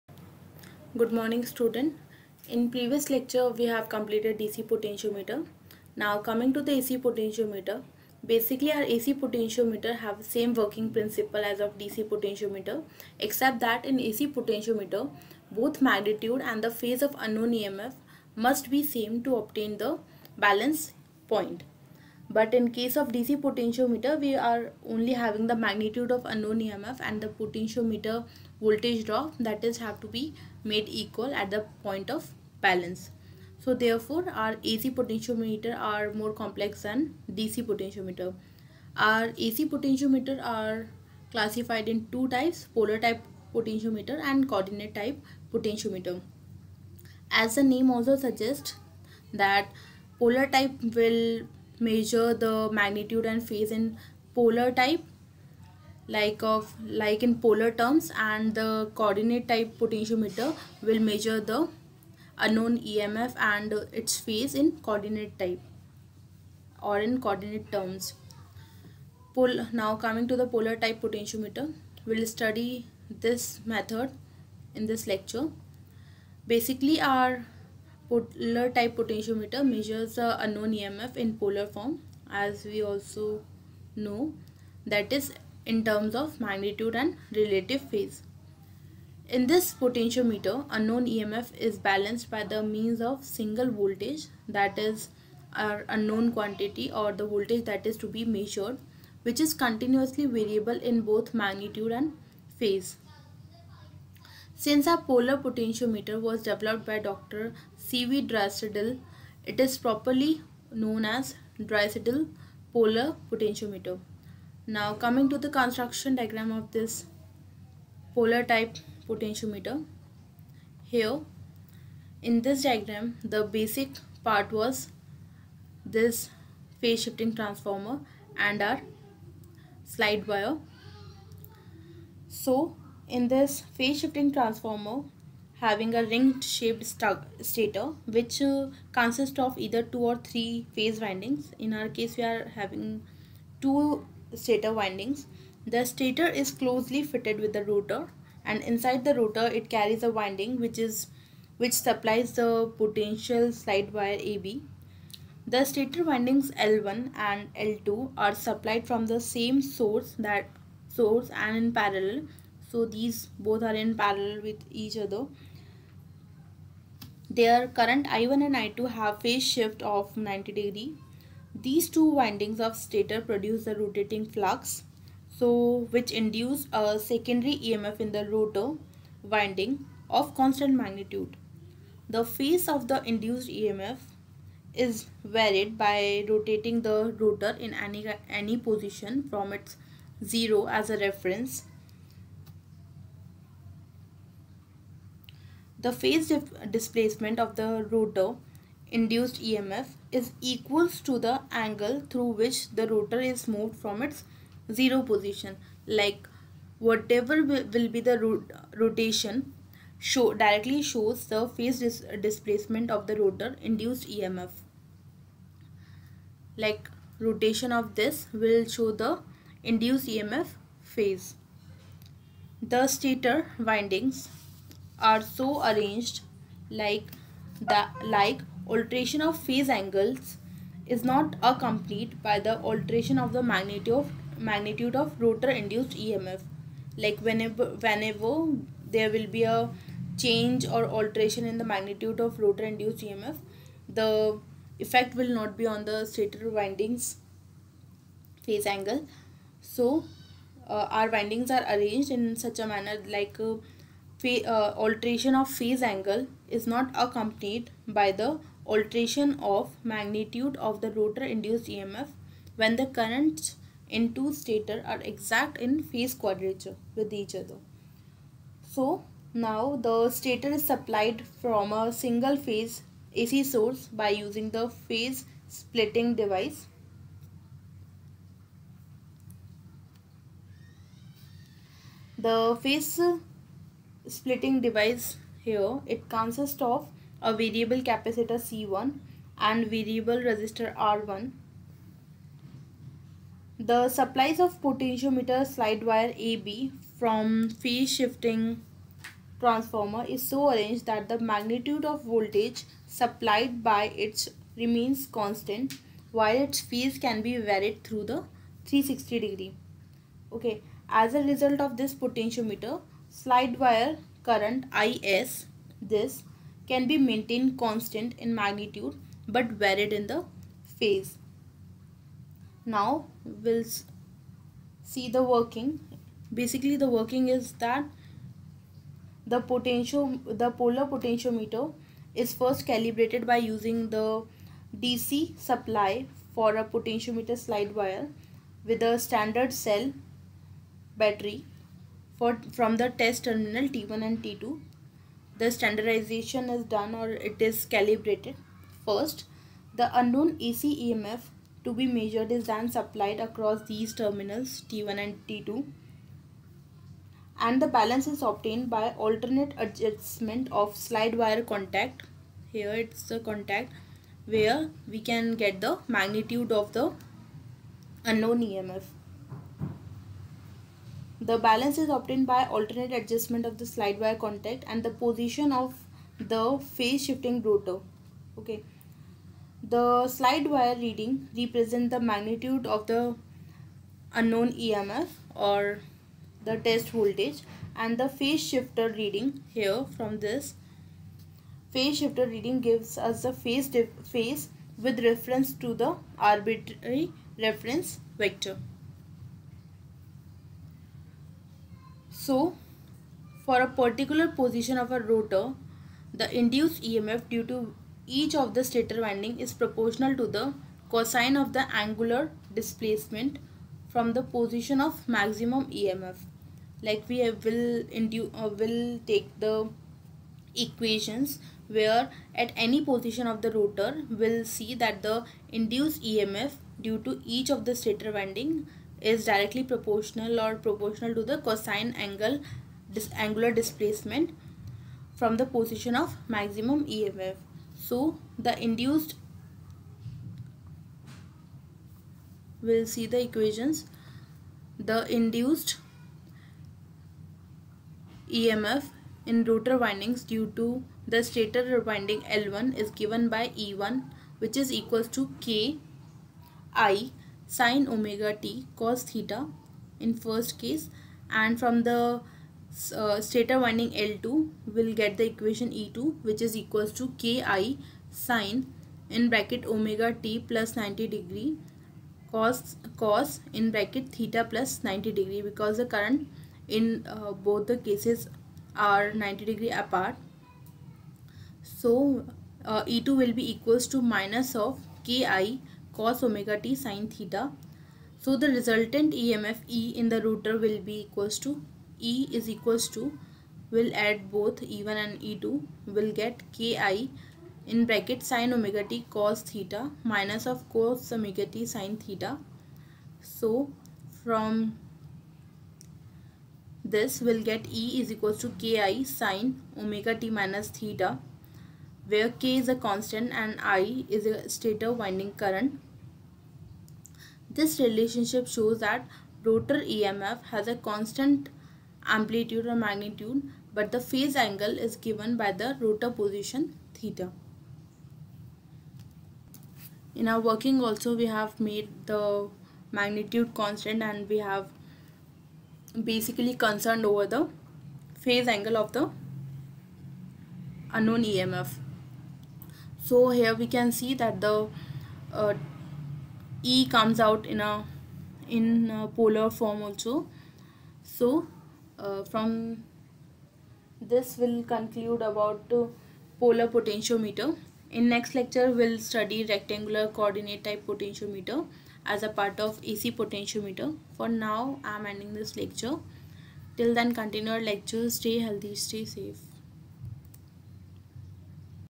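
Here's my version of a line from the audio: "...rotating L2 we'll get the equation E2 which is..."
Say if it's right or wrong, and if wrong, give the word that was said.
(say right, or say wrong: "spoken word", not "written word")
wrong: "winding", not "rotating".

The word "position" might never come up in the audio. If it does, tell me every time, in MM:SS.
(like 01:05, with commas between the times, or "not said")
03:08, 03:25, 06:14, 06:44, 06:54, 07:02, 07:15, 08:46.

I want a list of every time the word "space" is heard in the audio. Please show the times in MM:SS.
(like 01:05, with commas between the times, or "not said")
not said.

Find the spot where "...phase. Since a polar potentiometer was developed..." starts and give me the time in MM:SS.
01:42.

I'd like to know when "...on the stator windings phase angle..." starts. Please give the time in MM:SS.
04:05.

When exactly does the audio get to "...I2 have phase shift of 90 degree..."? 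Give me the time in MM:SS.
02:48.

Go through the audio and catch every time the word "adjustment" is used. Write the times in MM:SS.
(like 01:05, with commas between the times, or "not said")
05:59, 06:12.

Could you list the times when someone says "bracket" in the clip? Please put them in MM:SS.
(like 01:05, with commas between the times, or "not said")
07:49, 07:53, 08:17.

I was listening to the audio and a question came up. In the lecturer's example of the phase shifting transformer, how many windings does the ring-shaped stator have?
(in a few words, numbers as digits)
2.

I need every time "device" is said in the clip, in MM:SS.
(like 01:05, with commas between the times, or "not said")
04:36, 04:44.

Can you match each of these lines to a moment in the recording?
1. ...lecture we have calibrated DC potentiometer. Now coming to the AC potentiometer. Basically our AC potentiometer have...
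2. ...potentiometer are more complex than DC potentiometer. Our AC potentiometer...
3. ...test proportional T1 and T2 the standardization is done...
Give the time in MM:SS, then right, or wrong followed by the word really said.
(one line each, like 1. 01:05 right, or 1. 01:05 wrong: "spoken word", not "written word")
1. 00:03 wrong: "completed", not "calibrated"
2. 00:34 right
3. 05:42 wrong: "terminal", not "proportional".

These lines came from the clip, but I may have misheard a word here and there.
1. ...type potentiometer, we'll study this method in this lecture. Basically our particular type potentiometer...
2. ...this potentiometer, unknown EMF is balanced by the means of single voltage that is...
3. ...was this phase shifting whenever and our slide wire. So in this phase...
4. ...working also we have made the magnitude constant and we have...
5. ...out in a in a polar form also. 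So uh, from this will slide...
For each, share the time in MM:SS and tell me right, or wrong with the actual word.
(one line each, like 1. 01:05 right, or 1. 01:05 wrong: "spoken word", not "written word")
1. 01:10 wrong: "polar", not "particular"
2. 01:29 right
3. 02:04 wrong: "transformer", not "whenever"
4. 08:50 right
5. 09:07 wrong: "conclude", not "slide".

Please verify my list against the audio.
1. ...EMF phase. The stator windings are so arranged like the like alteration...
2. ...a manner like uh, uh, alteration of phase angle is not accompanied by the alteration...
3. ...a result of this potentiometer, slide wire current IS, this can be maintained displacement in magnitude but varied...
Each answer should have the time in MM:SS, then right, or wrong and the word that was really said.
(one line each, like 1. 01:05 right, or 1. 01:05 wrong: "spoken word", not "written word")
1. 03:40 right
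2. 04:12 right
3. 05:11 wrong: "constant", not "displacement".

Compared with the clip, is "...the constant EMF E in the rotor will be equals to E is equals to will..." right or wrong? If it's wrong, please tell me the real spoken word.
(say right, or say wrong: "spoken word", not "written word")
wrong: "resultant", not "constant".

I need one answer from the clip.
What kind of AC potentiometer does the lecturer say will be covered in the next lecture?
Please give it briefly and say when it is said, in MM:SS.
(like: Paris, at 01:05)
Rectangular coordinate type, at 09:19.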